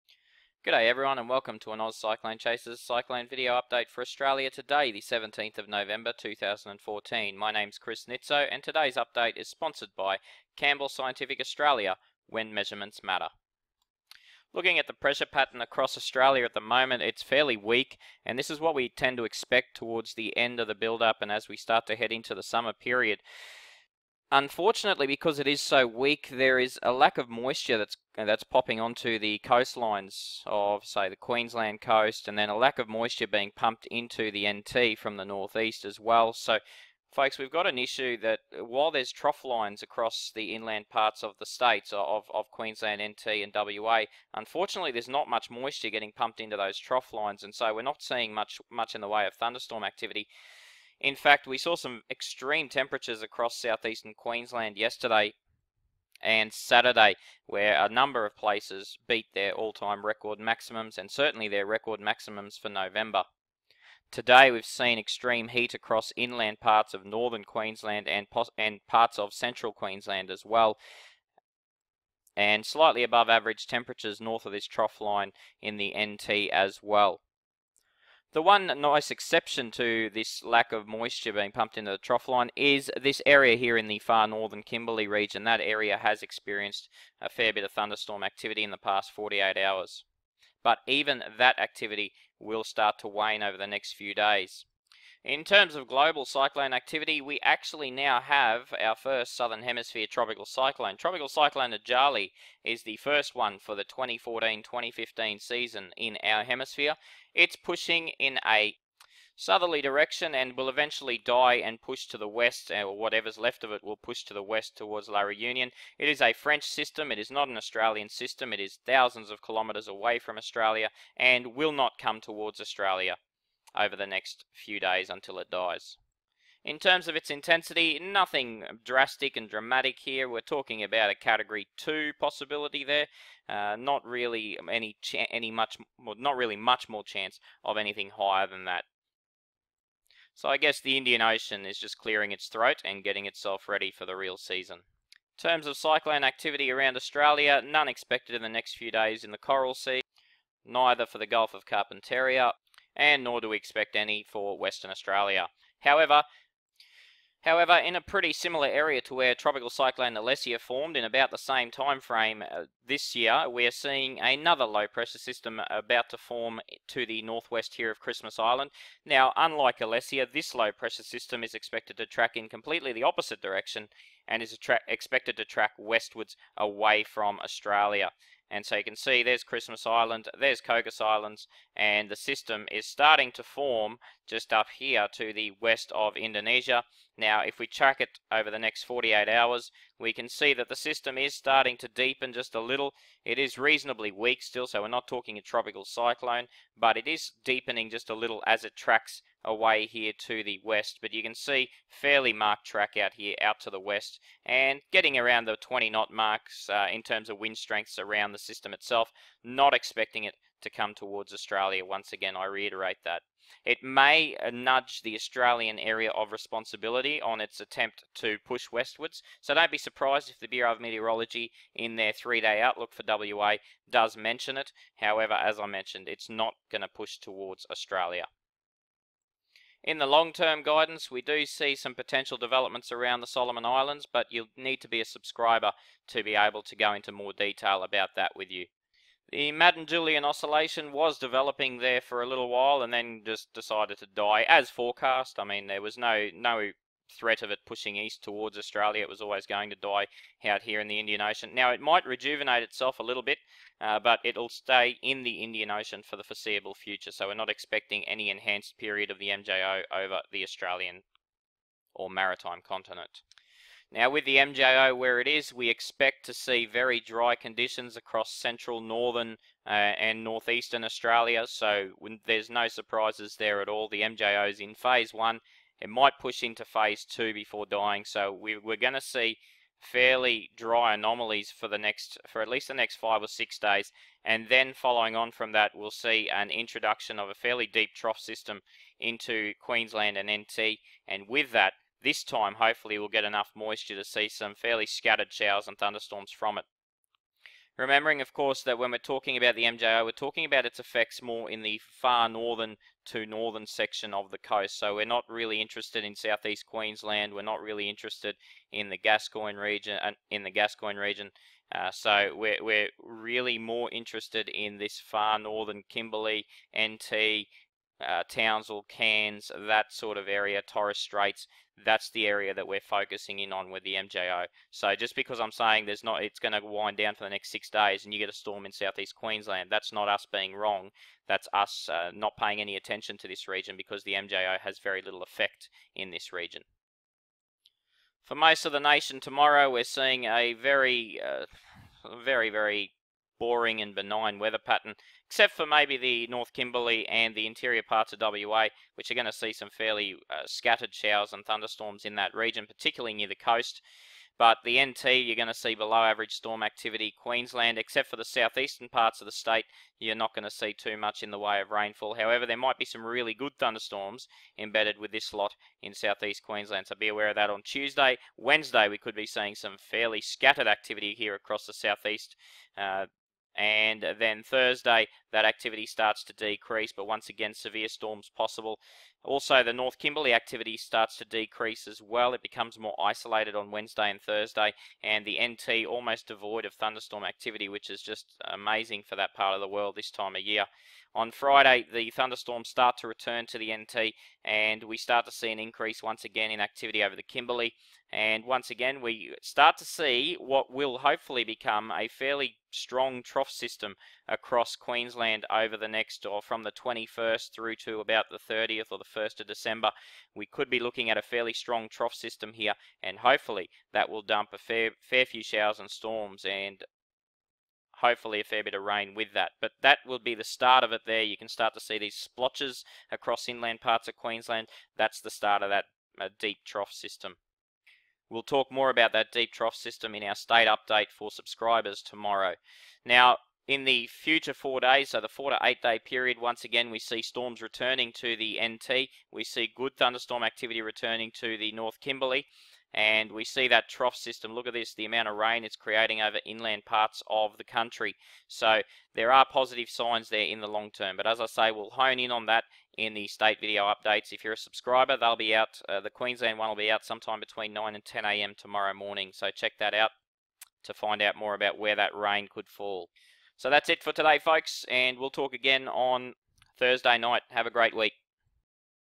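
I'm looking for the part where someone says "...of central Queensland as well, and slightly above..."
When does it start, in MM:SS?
01:09.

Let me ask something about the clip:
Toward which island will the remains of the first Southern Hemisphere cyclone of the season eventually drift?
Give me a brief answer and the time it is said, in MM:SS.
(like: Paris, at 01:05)
La Reunion, at 01:55.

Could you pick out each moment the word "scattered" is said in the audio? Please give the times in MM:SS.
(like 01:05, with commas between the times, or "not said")
04:54, 05:50, 06:10.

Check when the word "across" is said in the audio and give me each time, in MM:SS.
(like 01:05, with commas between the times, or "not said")
00:15, 00:39, 00:53, 01:05, 04:27, 06:11, 06:44, 07:03.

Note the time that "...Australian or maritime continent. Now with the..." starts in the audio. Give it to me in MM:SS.
04:20.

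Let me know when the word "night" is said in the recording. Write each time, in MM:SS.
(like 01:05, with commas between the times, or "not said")
07:47.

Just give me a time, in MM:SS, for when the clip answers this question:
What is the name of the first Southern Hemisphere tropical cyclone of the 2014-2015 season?
01:41.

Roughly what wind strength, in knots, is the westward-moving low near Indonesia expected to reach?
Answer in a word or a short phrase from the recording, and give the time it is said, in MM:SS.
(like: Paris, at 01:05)
20 knots, at 03:25.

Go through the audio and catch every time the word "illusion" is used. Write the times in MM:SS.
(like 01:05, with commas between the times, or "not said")
not said.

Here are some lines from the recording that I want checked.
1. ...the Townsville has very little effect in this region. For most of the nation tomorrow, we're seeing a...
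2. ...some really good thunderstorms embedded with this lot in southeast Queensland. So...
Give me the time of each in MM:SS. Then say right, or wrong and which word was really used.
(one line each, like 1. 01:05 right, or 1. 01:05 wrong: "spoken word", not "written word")
1. 05:34 wrong: "MJO", not "Townsville"
2. 06:02 right.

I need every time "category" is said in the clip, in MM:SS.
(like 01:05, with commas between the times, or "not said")
02:11.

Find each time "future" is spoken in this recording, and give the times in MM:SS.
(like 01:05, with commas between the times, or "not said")
04:16, 07:14.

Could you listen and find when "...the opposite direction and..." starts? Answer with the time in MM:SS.
02:52.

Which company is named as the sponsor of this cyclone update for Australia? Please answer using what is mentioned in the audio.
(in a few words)
Campbell Scientific Australia.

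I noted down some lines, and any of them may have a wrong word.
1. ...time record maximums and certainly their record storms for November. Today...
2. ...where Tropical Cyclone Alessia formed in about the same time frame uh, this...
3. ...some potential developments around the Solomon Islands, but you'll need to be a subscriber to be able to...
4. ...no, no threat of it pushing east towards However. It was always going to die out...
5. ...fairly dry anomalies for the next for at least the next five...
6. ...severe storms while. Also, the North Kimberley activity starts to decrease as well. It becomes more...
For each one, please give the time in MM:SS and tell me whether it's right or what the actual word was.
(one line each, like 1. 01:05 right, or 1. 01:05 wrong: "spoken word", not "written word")
1. 00:59 wrong: "maximums", not "storms"
2. 02:39 right
3. 03:51 right
4. 04:05 wrong: "Australia", not "However"
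5. 04:39 right
6. 06:17 wrong: "possible", not "while".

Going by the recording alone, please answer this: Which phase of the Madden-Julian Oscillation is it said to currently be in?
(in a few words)
Phase 1.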